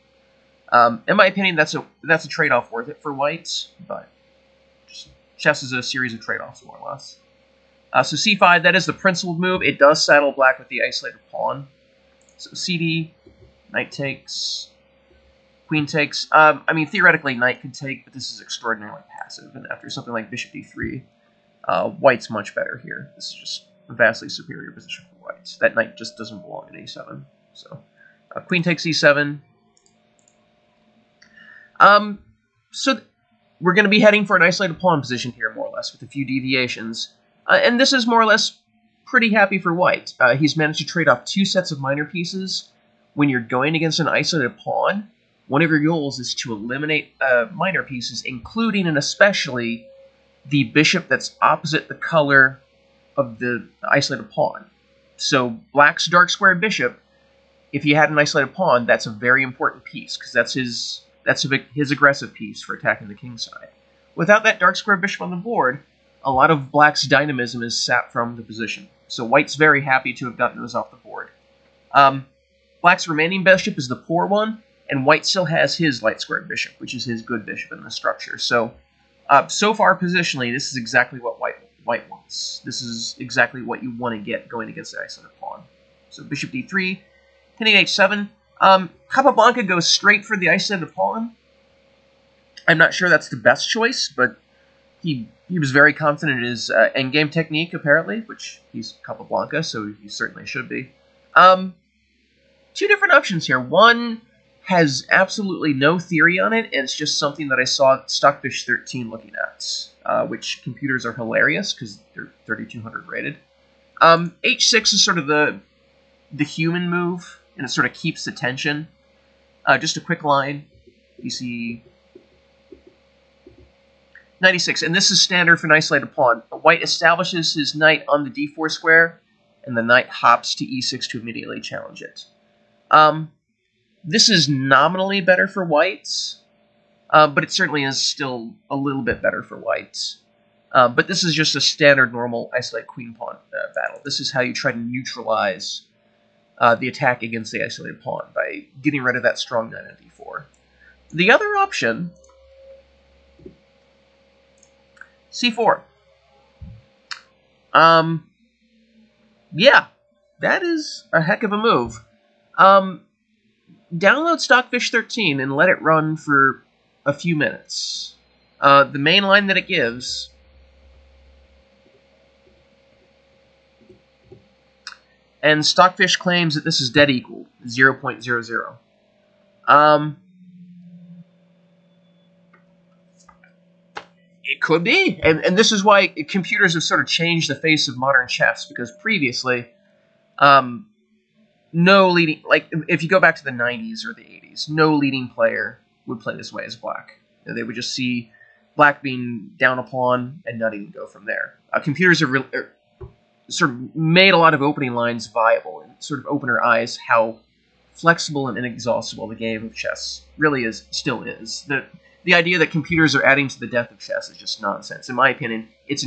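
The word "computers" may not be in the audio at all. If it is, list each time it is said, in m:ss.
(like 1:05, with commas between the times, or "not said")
1:50, 3:06, 3:21, 3:32.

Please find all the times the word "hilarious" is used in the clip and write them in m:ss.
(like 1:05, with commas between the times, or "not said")
1:51.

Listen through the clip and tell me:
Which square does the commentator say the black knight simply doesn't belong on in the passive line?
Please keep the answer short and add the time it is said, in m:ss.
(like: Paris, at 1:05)
a7, at 0:26.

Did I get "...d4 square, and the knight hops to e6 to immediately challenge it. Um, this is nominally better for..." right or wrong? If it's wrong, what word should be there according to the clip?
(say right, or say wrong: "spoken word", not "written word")
right.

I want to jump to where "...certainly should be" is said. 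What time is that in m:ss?
1:40.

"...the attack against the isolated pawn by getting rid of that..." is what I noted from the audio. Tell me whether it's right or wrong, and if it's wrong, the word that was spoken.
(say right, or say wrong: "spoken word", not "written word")
right.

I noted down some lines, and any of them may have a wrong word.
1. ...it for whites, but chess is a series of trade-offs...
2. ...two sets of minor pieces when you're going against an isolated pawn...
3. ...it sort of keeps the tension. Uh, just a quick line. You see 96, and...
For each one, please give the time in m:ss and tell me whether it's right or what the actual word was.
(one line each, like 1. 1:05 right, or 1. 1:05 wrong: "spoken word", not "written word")
1. 0:02 right
2. 0:41 right
3. 1:57 right.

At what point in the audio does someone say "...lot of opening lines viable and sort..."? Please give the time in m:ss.
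3:24.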